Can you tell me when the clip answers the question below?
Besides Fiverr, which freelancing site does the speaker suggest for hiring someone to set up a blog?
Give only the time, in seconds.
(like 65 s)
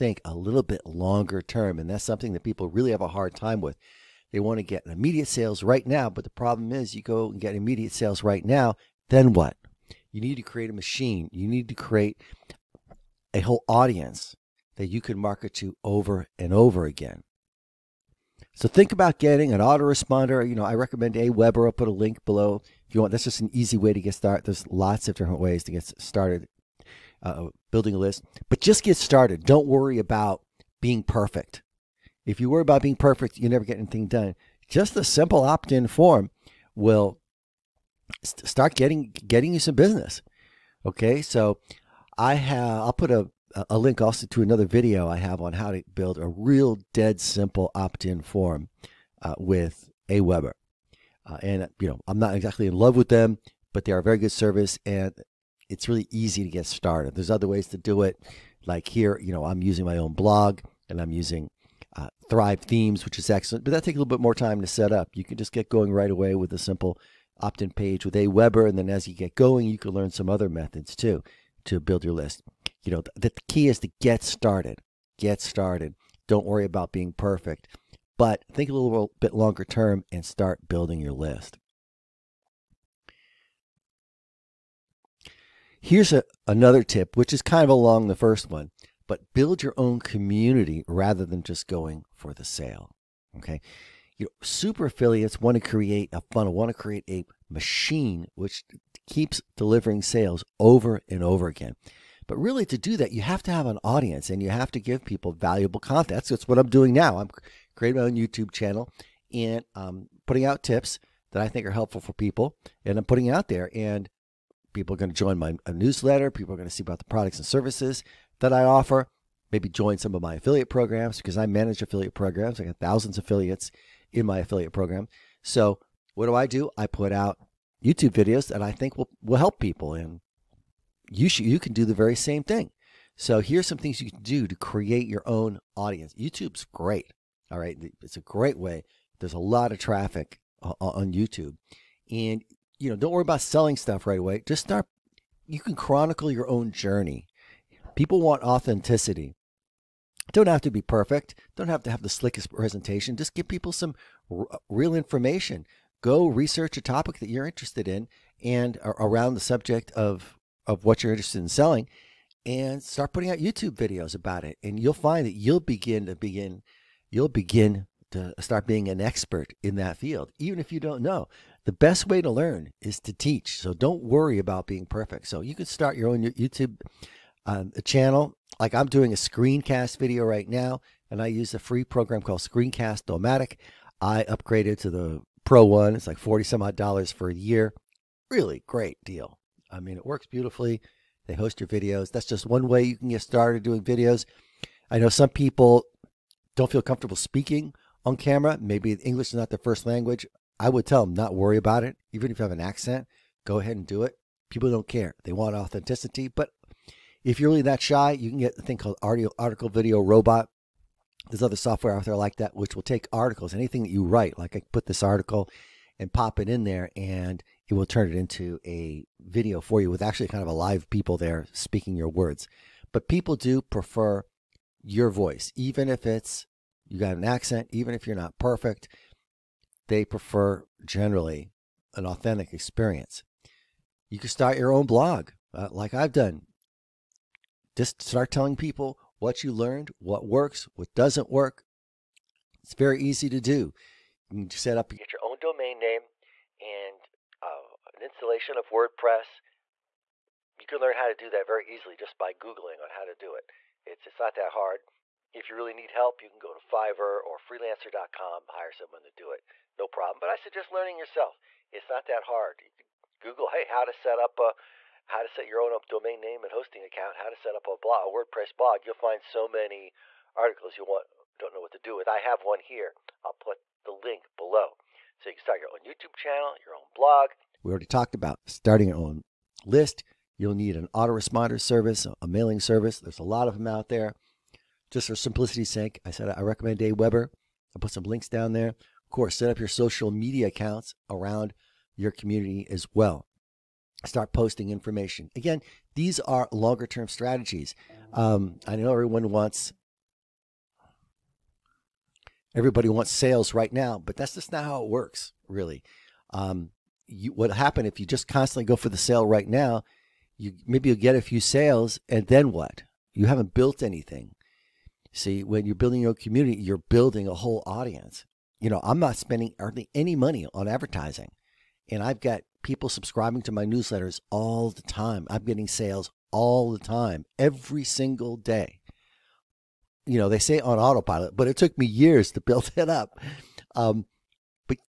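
257 s.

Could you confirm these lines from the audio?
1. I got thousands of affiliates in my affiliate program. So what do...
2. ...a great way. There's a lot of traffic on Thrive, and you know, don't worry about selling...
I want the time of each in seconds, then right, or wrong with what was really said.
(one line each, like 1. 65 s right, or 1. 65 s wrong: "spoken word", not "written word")
1. 122 s right
2. 138 s wrong: "YouTube", not "Thrive".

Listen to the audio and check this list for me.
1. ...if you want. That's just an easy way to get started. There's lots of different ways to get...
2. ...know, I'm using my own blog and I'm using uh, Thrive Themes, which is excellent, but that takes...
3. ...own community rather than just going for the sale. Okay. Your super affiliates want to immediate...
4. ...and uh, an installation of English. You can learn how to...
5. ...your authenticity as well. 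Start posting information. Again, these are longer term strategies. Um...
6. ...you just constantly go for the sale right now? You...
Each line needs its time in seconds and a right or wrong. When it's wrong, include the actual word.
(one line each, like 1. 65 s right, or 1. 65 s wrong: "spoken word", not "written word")
1. 22 s right
2. 59 s right
3. 89 s wrong: "create", not "immediate"
4. 246 s wrong: "WordPress", not "English"
5. 291 s wrong: "community", not "authenticity"
6. 308 s right.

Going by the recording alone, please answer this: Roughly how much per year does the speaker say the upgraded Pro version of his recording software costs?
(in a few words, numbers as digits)
40 some odd dollars.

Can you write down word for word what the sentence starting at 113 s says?
And People are going to join my newsletter.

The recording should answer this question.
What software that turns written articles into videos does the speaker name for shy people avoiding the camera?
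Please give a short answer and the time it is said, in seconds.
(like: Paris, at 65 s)
article video robot, at 209 s.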